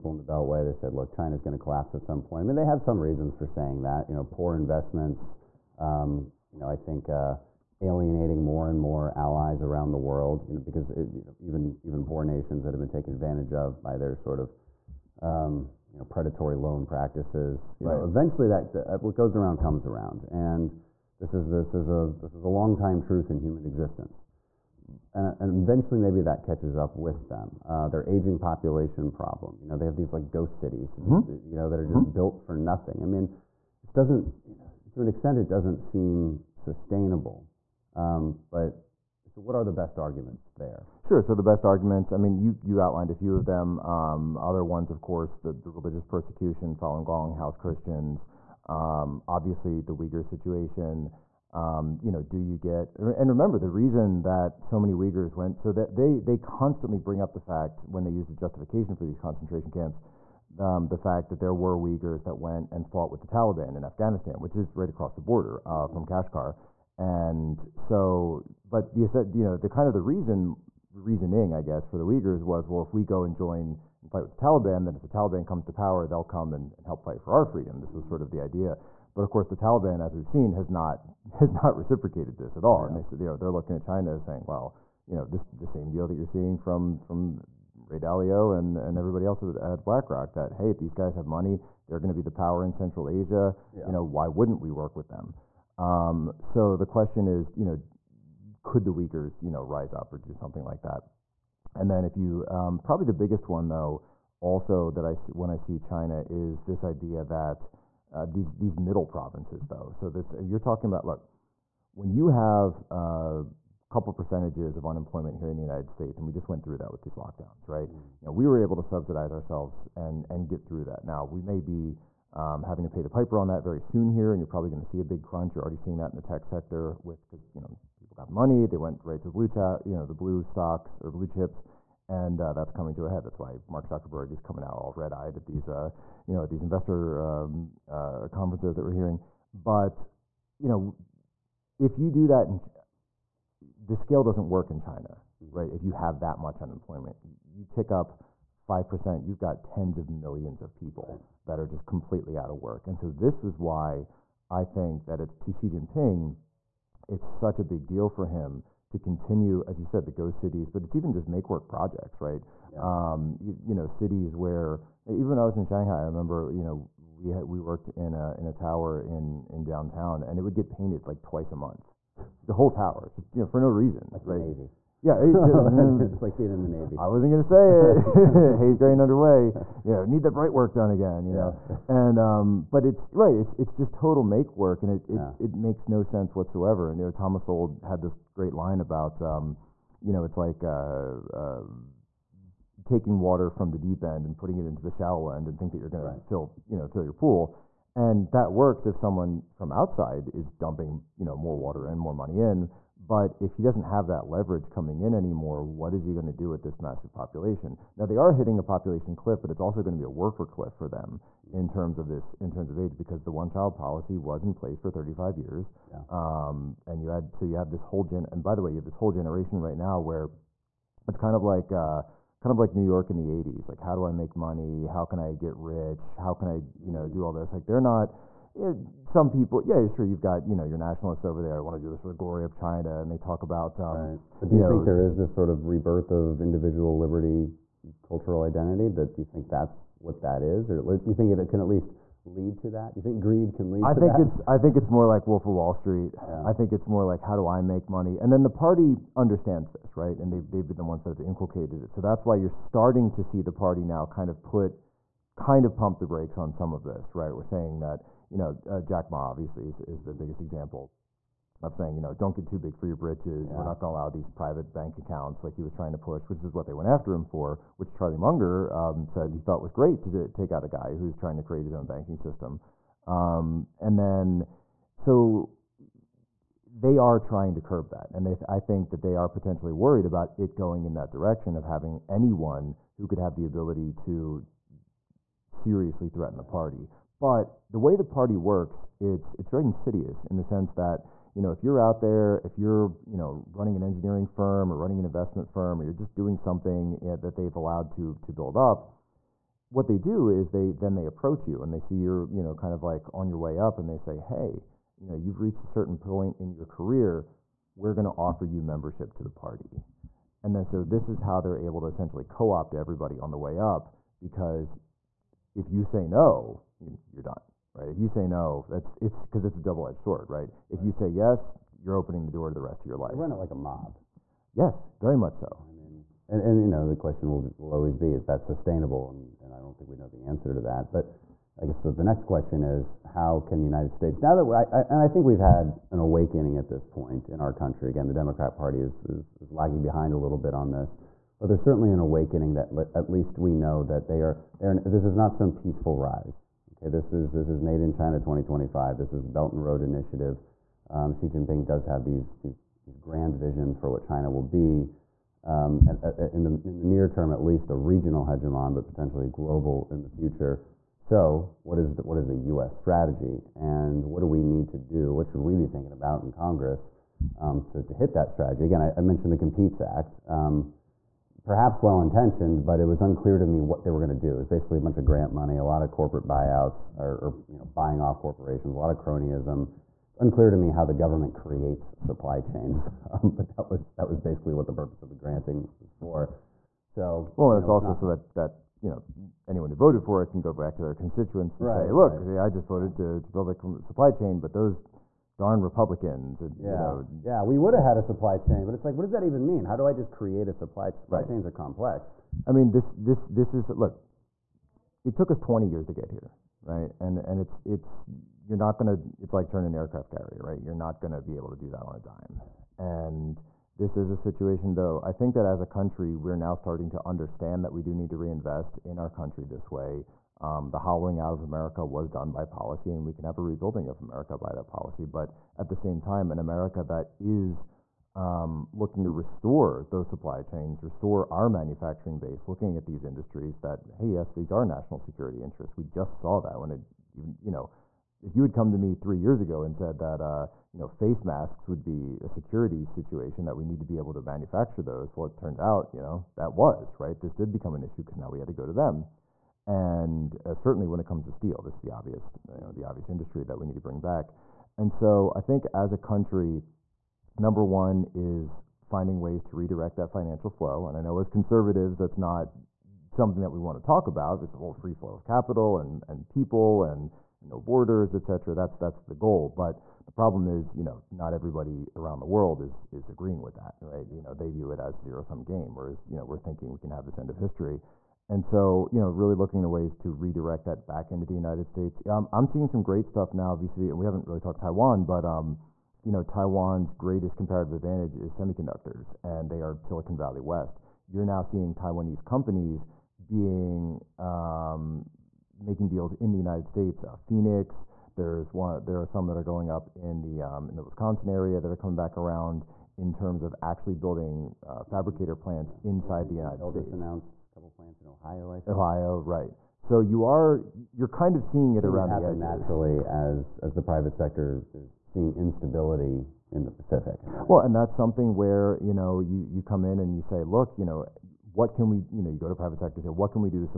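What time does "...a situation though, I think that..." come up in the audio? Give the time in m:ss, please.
6:54.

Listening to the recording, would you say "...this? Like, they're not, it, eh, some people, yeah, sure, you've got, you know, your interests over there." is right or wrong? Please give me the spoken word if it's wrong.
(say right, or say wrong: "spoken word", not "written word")
wrong: "nationalists", not "interests".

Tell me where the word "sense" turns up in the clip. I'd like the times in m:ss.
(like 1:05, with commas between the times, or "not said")
3:06, 4:50.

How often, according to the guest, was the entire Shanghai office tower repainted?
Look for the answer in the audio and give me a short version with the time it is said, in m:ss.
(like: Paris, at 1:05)
twice a month, at 2:51.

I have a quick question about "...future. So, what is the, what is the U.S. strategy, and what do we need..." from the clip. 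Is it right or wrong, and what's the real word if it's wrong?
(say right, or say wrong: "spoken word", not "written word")
right.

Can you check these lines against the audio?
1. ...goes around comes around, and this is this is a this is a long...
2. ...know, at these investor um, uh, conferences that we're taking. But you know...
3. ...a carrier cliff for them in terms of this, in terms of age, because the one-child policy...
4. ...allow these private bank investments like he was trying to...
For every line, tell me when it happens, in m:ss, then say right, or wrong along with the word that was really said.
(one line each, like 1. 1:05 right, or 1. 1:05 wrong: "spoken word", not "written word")
1. 0:19 right
2. 2:16 wrong: "hearing", not "taking"
3. 3:30 wrong: "worker", not "carrier"
4. 4:23 wrong: "accounts", not "investments".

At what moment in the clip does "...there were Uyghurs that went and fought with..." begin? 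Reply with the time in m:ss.
1:01.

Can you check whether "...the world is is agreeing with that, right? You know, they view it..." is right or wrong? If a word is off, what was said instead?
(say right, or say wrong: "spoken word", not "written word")
right.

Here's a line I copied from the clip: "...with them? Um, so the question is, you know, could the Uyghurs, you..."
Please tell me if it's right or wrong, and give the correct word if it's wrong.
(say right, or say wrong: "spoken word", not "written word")
right.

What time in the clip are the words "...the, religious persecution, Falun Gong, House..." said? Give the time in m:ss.
0:45.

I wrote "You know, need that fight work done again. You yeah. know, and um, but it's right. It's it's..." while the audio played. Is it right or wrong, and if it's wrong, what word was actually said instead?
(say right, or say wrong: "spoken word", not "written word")
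wrong: "bright", not "fight".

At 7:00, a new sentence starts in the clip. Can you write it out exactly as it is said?
Um, the hollowing out of America was done by policy, and we can have a rebuilding of America by that policy.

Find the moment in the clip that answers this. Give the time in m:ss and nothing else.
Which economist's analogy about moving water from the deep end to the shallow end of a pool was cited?
3:07.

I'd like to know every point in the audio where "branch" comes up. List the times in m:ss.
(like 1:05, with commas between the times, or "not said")
not said.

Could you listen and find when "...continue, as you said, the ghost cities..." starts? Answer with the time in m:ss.
2:38.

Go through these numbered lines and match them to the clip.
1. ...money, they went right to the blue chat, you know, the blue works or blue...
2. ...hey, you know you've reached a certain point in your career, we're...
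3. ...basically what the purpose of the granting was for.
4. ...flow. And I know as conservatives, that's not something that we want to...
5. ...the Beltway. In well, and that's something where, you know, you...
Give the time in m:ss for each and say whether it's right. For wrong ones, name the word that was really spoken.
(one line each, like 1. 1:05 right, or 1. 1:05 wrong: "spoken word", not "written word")
1. 2:08 wrong: "stocks", not "works"
2. 5:04 right
3. 6:24 right
4. 7:40 right
5. 8:36 wrong: "Pacific", not "Beltway".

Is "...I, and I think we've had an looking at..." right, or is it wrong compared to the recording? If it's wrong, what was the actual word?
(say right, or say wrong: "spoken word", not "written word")
wrong: "awakening", not "looking".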